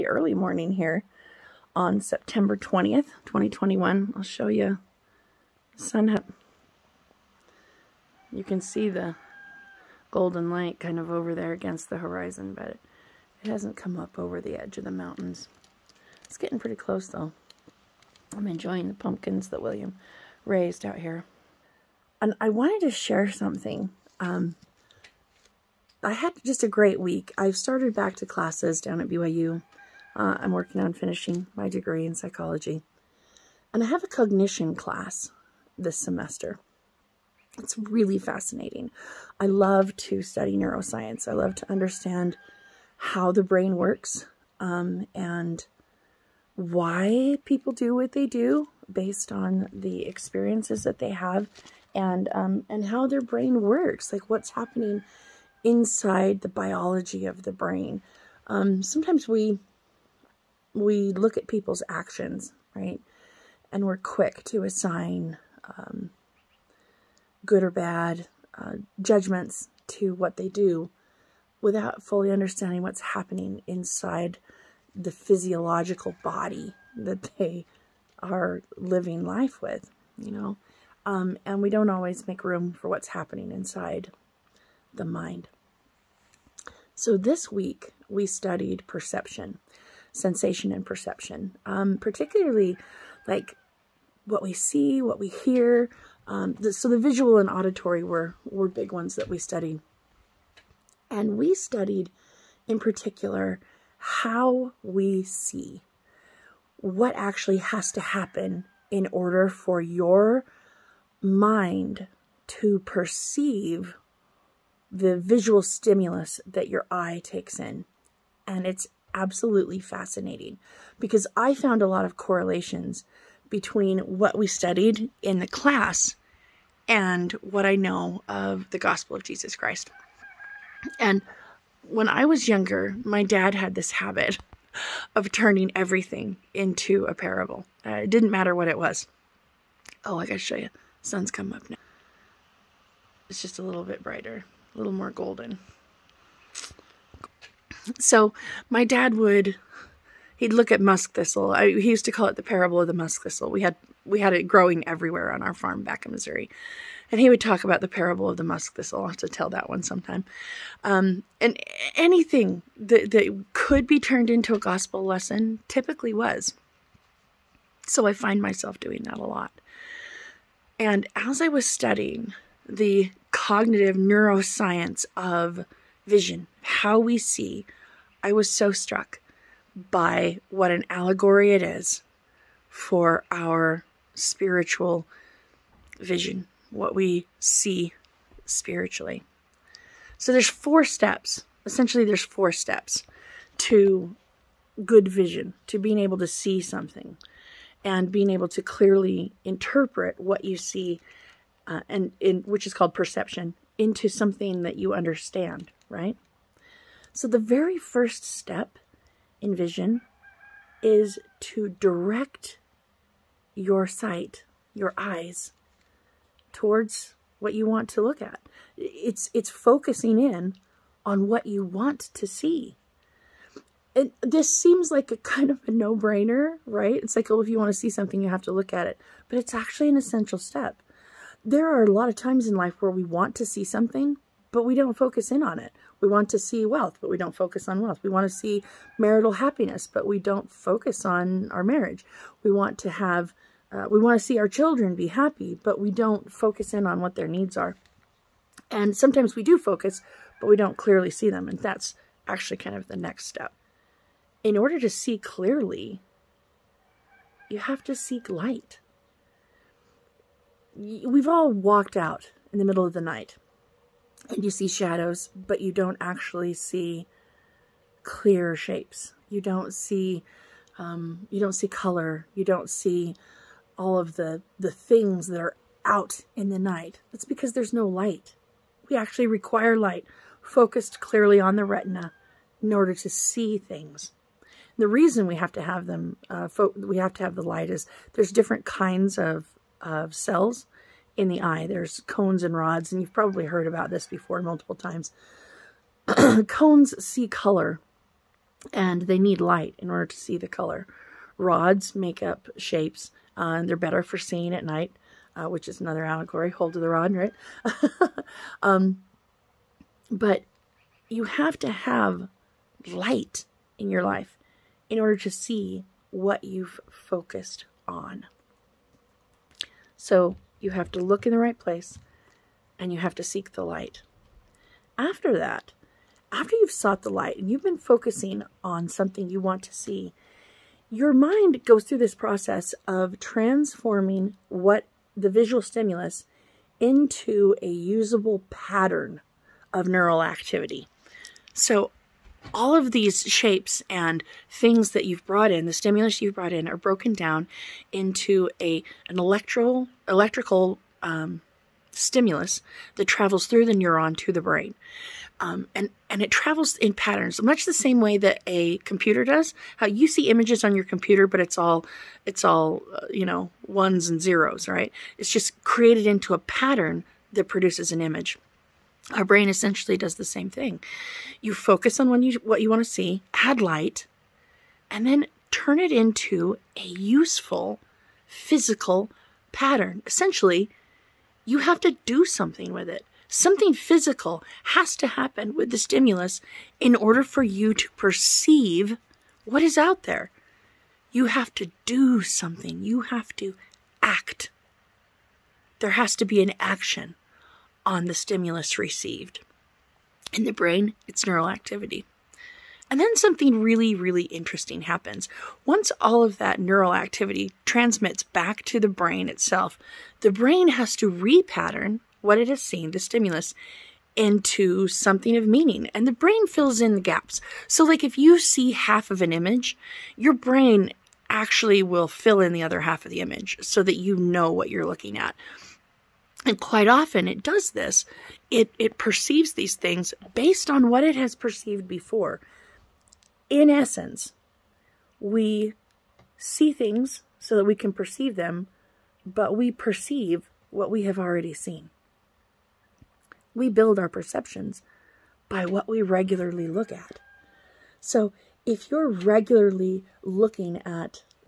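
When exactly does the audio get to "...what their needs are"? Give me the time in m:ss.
4:07.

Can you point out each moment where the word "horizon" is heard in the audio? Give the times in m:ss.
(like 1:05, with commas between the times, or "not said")
0:11.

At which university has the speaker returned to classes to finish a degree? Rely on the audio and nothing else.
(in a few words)
BYU.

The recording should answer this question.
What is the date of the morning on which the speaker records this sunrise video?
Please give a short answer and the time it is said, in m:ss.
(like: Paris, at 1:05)
September 20th, 2021, at 0:02.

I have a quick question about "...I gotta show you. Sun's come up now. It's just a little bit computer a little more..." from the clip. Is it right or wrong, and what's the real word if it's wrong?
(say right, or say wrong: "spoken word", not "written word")
wrong: "brighter", not "computer".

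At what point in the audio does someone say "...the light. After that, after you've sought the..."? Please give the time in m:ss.
5:23.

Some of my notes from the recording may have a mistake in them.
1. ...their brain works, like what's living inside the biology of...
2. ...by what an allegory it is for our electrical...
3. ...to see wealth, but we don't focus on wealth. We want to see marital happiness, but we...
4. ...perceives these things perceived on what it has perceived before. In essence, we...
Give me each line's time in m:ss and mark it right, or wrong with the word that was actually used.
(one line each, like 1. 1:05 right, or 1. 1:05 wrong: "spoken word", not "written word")
1. 0:53 wrong: "happening", not "living"
2. 2:59 wrong: "spiritual", not "electrical"
3. 3:56 right
4. 7:08 wrong: "based", not "perceived".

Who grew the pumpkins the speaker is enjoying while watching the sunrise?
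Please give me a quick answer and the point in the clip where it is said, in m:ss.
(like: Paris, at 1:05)
William, at 0:19.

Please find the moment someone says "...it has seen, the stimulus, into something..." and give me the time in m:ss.
6:52.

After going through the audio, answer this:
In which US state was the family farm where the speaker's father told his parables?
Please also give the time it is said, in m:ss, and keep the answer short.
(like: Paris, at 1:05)
Missouri, at 2:36.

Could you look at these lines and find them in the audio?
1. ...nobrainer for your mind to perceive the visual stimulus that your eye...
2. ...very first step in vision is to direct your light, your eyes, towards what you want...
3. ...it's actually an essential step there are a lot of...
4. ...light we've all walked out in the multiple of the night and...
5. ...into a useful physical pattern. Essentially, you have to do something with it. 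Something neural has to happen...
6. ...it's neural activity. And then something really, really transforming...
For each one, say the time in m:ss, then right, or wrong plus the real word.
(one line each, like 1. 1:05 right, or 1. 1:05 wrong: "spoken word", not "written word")
1. 1:49 wrong: "order", not "nobrainer"
2. 3:27 wrong: "sight", not "light"
3. 3:49 right
4. 4:18 wrong: "middle", not "multiple"
5. 6:15 wrong: "physical", not "neural"
6. 6:41 wrong: "interesting", not "transforming".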